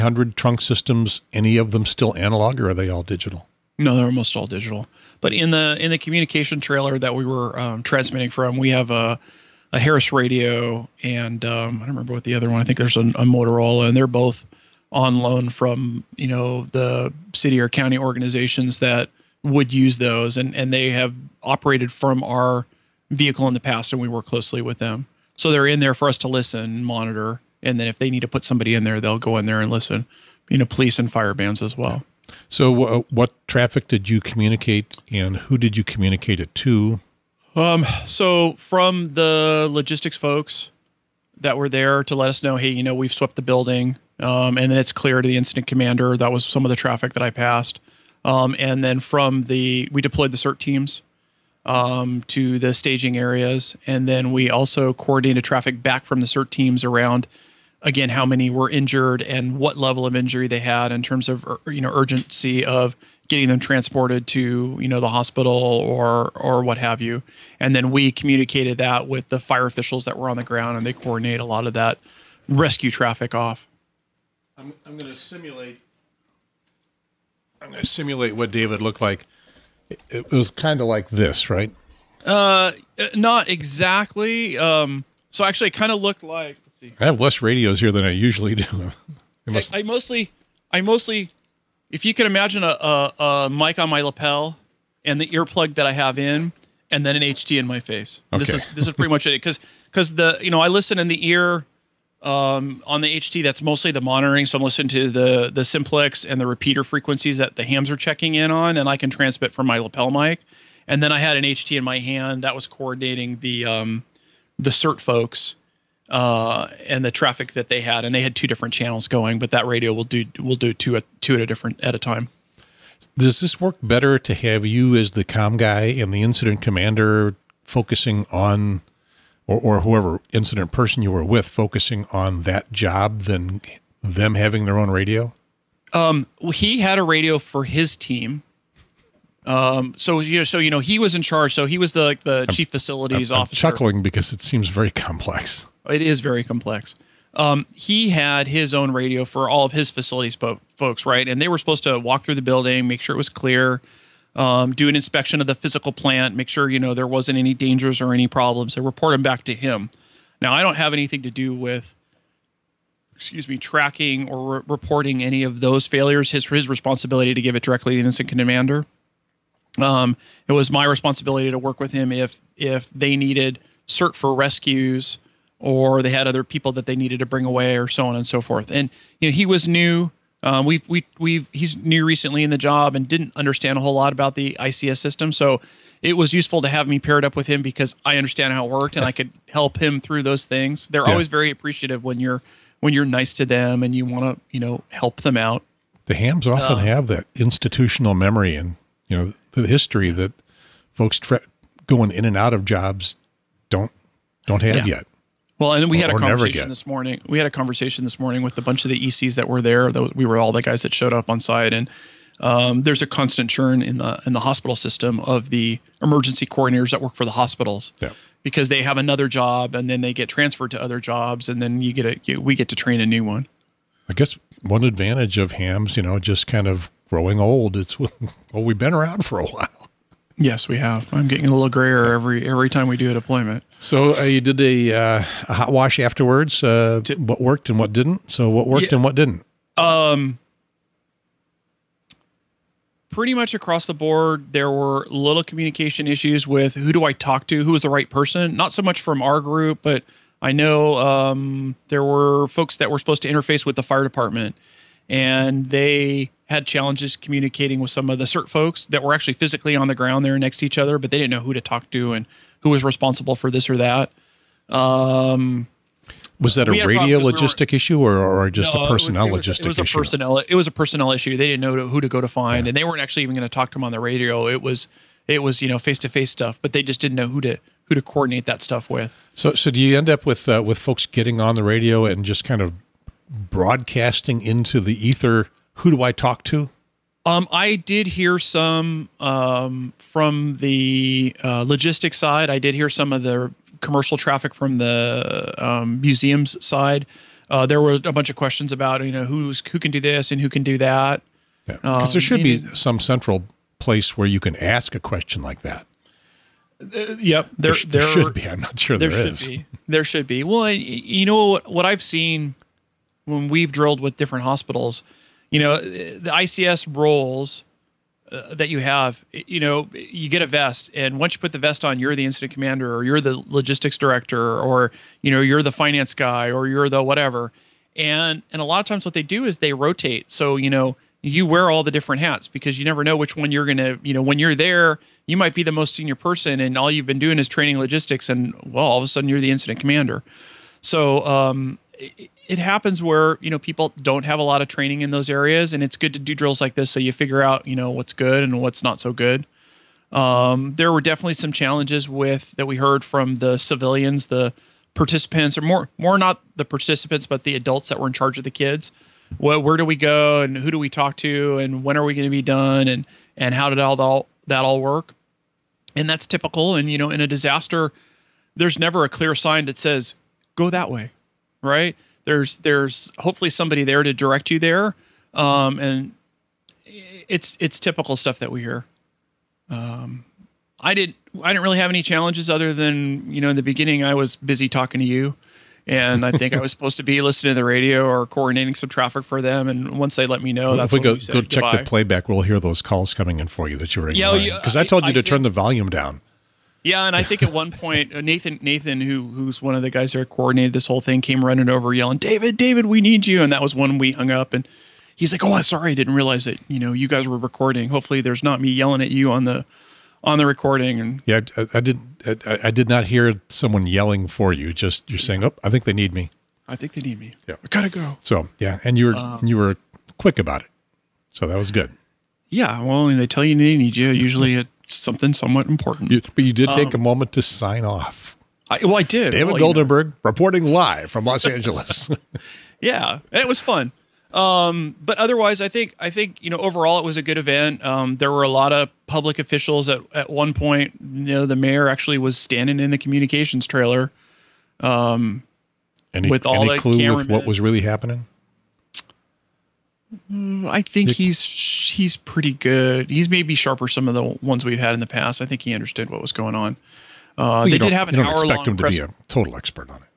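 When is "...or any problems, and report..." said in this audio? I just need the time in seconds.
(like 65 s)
158 s.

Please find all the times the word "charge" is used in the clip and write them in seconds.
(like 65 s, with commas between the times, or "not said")
141 s, 358 s.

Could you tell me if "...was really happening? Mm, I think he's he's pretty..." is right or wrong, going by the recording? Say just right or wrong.
right.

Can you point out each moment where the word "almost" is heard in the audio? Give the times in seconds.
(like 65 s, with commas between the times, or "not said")
4 s.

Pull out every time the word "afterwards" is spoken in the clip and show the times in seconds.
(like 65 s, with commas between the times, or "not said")
235 s.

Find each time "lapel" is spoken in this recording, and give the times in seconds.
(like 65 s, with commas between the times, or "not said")
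94 s, 109 s.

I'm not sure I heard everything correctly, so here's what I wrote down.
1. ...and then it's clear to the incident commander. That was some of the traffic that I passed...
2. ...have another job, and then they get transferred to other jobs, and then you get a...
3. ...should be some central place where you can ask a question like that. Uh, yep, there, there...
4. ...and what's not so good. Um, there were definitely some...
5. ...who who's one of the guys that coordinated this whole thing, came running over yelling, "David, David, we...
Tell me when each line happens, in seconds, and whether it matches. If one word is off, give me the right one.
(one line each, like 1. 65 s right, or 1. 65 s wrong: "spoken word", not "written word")
1. 44 s right
2. 218 s right
3. 302 s right
4. 348 s right
5. 399 s right.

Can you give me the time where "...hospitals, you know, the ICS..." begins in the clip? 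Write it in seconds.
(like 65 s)
314 s.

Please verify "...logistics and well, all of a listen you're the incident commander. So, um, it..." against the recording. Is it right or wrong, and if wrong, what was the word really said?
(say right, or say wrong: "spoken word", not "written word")
wrong: "sudden", not "listen".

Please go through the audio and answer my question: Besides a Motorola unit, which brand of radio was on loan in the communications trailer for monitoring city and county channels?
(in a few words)
Harris.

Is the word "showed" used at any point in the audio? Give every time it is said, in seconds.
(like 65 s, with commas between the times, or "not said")
210 s.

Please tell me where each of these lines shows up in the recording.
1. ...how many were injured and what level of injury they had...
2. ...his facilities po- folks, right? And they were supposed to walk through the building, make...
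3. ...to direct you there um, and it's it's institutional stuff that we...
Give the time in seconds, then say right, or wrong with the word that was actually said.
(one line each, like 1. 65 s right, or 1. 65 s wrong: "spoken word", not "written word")
1. 58 s right
2. 149 s right
3. 374 s wrong: "typical", not "institutional".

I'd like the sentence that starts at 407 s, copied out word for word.
Hopefully, there's not me yelling at you on the on the recording.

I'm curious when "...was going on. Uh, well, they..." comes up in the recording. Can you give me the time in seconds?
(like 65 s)
456 s.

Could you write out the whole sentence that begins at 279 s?
So, so do you end up with uh, with folks getting on the radio and just kind of broadcasting into the ether?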